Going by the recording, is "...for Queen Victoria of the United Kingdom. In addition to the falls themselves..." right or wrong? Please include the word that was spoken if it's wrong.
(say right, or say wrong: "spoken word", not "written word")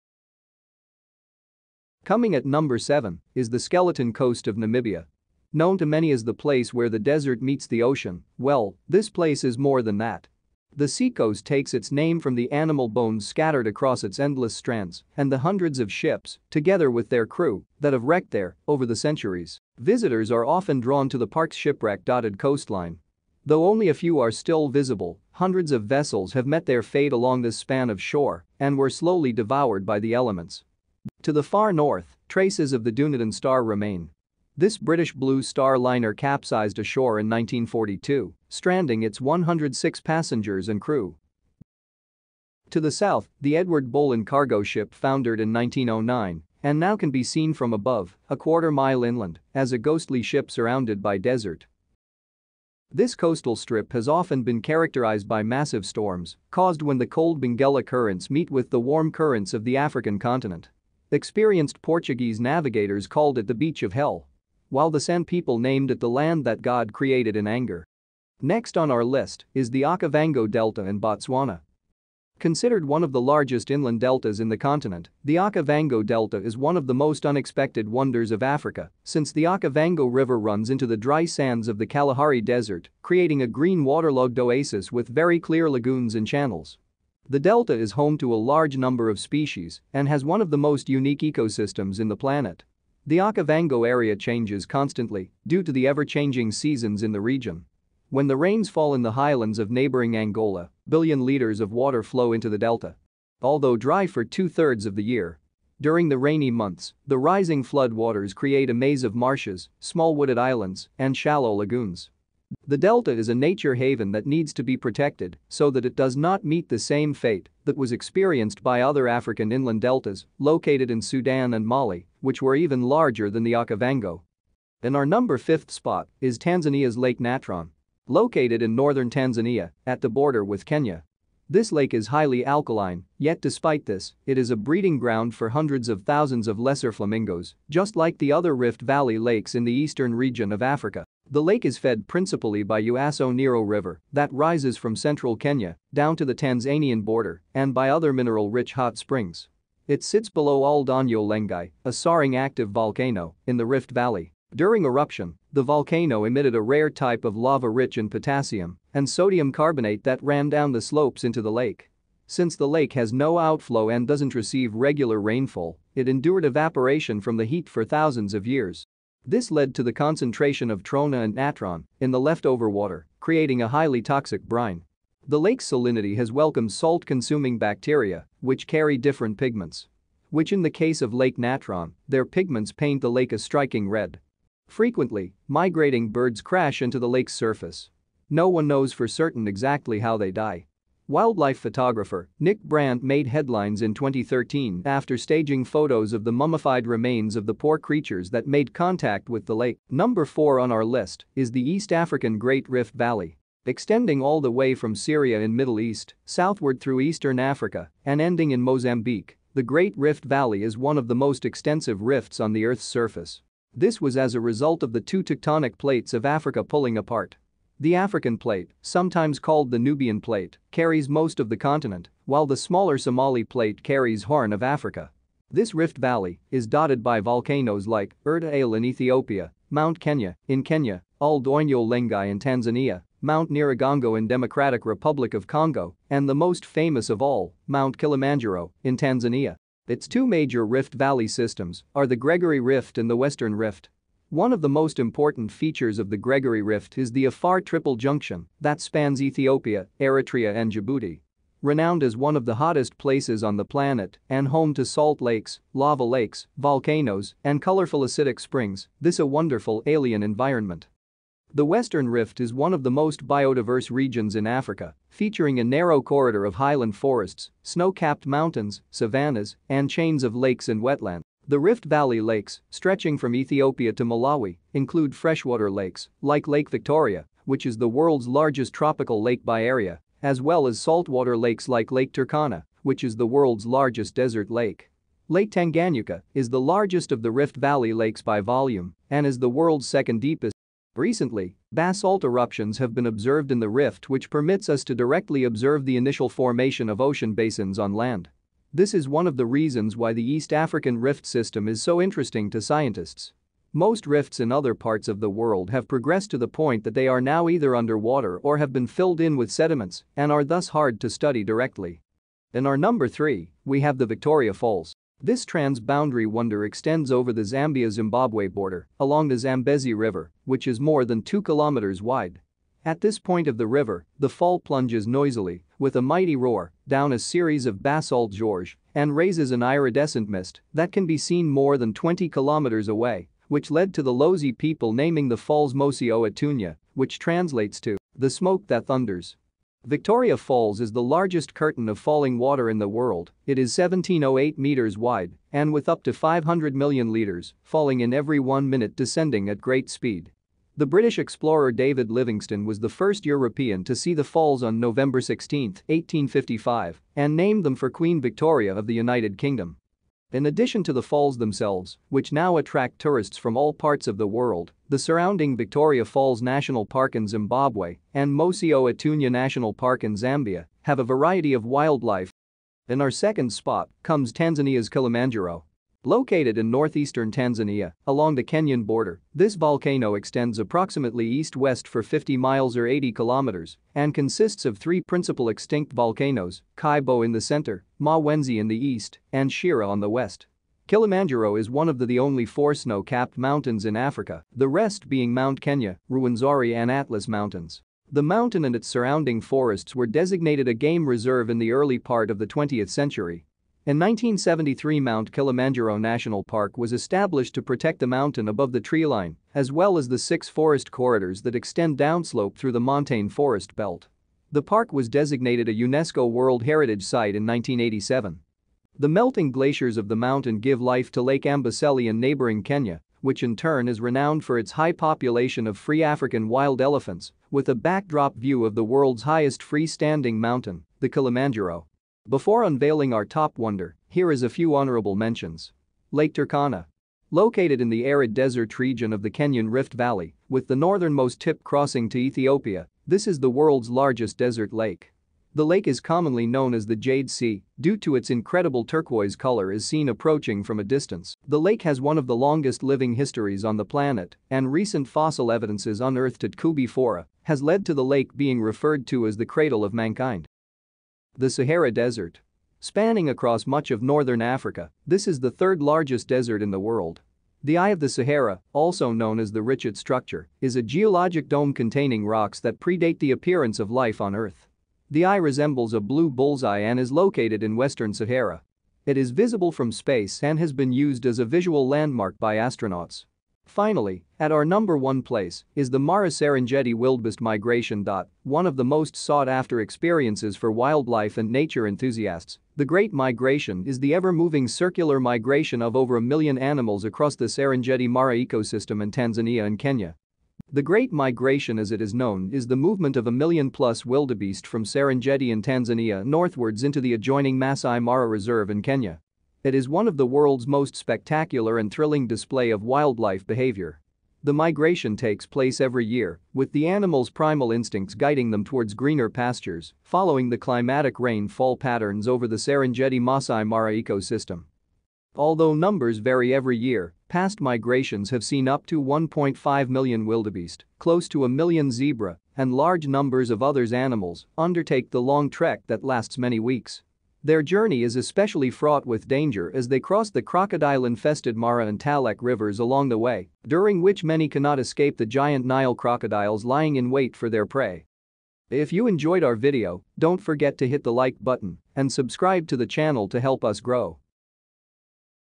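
right.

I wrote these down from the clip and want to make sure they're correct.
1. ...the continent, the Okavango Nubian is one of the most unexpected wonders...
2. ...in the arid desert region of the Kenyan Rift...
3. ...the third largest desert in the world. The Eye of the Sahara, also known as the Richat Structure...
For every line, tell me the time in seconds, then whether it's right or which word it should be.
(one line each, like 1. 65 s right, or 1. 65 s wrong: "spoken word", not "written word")
1. 74 s wrong: "Delta", not "Nubian"
2. 437 s right
3. 465 s right.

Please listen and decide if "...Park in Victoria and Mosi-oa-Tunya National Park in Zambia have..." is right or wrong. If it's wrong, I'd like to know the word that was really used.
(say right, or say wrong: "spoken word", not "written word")
wrong: "Zimbabwe", not "Victoria".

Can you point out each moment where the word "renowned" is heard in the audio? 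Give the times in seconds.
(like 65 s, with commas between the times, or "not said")
251 s, 423 s.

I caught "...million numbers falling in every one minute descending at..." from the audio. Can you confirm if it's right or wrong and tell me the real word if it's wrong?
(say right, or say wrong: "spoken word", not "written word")
wrong: "liters", not "numbers".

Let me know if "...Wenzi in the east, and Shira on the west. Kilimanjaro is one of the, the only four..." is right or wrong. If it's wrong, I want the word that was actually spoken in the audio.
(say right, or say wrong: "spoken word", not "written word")
right.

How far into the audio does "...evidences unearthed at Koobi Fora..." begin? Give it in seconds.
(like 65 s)
455 s.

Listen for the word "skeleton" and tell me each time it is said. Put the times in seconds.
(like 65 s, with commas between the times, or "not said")
3 s.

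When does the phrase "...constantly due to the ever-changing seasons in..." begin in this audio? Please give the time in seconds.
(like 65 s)
94 s.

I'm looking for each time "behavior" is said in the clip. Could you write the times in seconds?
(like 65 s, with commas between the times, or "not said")
513 s.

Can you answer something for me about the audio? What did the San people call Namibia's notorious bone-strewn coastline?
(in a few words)
The land that God created in anger.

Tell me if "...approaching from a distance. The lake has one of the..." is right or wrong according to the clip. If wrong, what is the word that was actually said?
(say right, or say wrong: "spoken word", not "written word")
right.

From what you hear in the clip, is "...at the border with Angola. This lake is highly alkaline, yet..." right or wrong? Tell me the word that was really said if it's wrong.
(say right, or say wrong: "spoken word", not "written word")
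wrong: "Kenya", not "Angola".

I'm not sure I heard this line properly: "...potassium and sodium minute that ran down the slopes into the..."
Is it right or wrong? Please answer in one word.
wrong.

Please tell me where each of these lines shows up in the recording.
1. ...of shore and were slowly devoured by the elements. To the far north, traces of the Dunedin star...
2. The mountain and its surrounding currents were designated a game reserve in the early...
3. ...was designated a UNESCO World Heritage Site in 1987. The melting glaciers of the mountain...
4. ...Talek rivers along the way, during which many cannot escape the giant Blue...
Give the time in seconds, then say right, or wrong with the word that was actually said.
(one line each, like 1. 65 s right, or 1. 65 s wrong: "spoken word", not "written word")
1. 27 s right
2. 398 s wrong: "forests", not "currents"
3. 414 s right
4. 541 s wrong: "Nile", not "Blue".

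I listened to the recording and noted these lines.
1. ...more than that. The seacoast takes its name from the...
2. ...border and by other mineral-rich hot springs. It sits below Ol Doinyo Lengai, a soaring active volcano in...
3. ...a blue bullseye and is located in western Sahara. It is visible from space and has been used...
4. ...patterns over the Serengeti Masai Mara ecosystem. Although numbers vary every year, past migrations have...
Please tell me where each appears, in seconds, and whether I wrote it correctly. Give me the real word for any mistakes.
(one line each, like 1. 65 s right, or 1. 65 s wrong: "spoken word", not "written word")
1. 9 s right
2. 147 s right
3. 475 s right
4. 521 s right.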